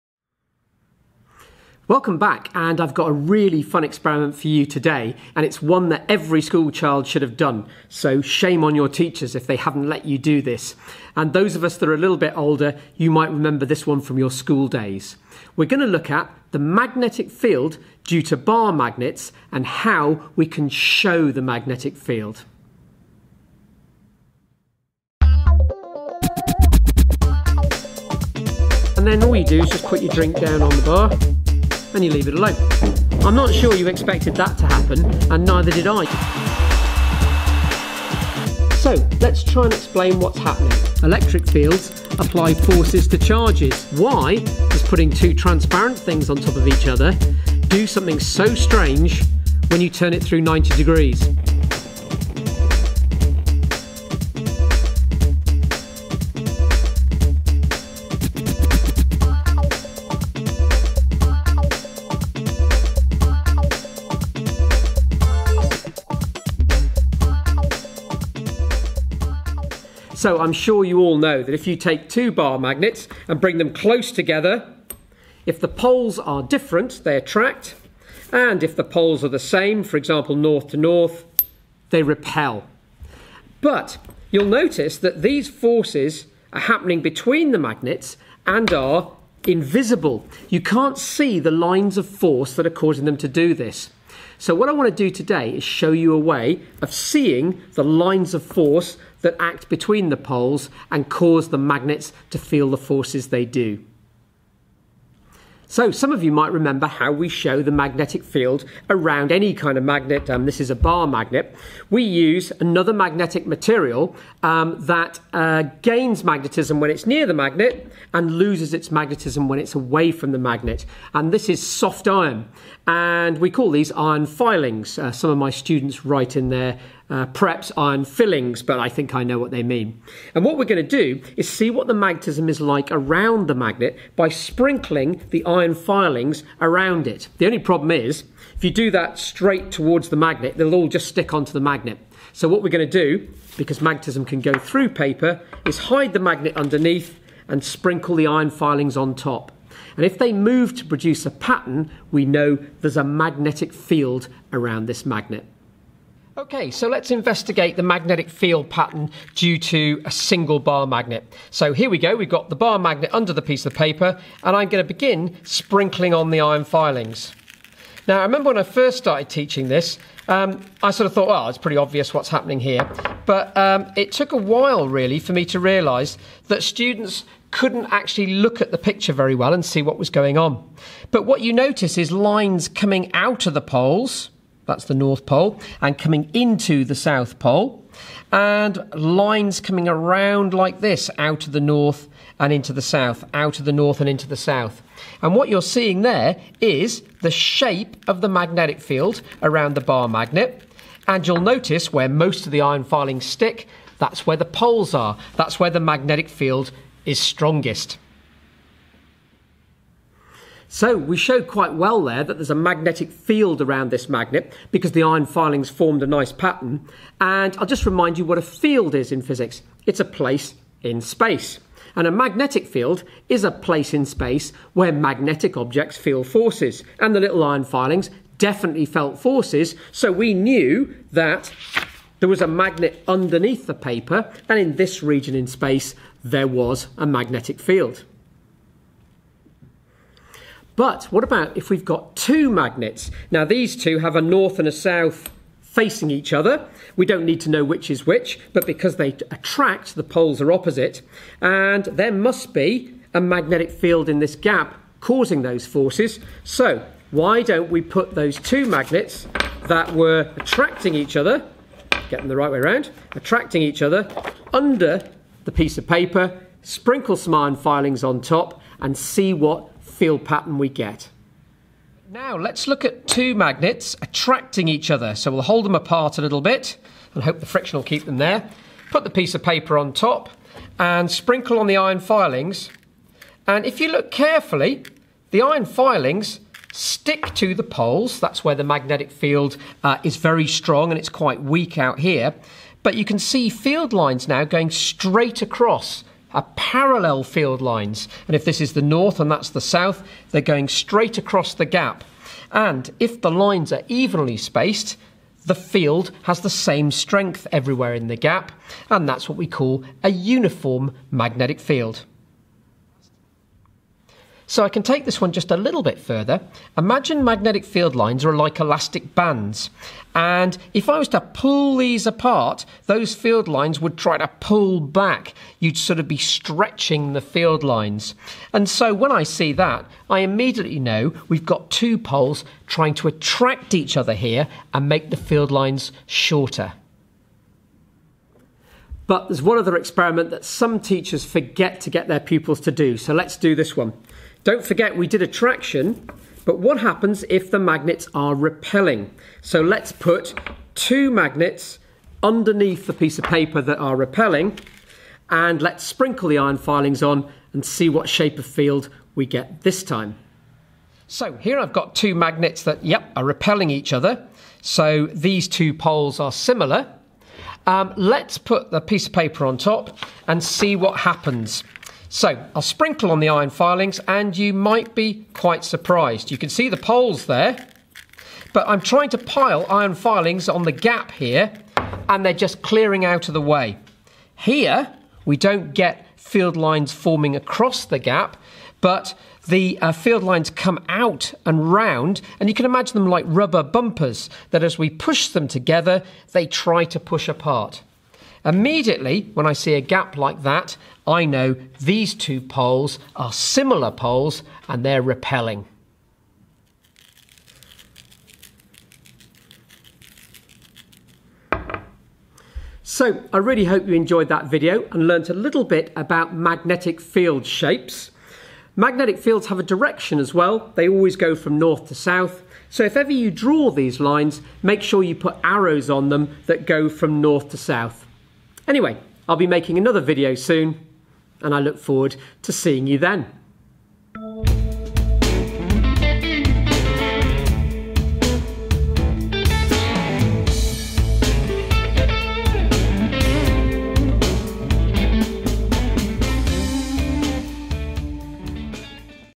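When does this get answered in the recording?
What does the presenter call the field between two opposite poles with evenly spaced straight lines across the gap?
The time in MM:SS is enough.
05:10.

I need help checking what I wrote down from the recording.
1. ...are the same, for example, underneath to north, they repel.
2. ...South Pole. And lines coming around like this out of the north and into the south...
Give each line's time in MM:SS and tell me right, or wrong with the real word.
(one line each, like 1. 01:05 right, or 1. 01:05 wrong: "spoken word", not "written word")
1. 01:19 wrong: "north", not "underneath"
2. 03:06 right.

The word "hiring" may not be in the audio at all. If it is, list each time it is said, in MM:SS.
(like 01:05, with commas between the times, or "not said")
not said.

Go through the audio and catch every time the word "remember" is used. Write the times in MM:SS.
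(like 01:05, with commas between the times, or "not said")
00:13, 01:46, 02:48.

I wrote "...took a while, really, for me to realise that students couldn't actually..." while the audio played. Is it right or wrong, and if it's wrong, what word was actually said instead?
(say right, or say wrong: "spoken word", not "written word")
right.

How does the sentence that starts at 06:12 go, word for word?
So I'll sprinkle on the iron filings and you might be quite surprised.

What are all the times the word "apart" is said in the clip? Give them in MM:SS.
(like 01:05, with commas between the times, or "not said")
04:35, 05:22, 06:37.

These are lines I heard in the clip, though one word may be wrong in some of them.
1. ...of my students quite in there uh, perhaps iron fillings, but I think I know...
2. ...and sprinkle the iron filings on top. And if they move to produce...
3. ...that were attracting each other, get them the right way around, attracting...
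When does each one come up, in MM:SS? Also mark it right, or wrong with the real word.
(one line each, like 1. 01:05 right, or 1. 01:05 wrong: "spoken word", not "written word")
1. 02:05 wrong: "write", not "quite"
2. 02:27 right
3. 04:19 right.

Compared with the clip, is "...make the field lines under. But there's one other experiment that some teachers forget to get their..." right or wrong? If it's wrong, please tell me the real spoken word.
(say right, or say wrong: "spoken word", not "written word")
wrong: "shorter", not "under".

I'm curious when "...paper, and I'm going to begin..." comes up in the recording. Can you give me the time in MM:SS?
02:43.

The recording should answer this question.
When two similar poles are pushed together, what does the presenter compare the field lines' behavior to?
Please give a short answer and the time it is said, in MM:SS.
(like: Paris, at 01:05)
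rubber bumpers, at 06:33.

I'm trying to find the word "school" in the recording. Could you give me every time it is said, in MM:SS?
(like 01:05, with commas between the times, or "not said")
00:06, 00:14.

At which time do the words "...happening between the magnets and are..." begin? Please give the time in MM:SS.
01:26.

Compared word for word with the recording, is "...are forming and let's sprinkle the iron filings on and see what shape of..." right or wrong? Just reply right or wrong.
wrong.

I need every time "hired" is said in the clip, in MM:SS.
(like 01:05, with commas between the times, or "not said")
not said.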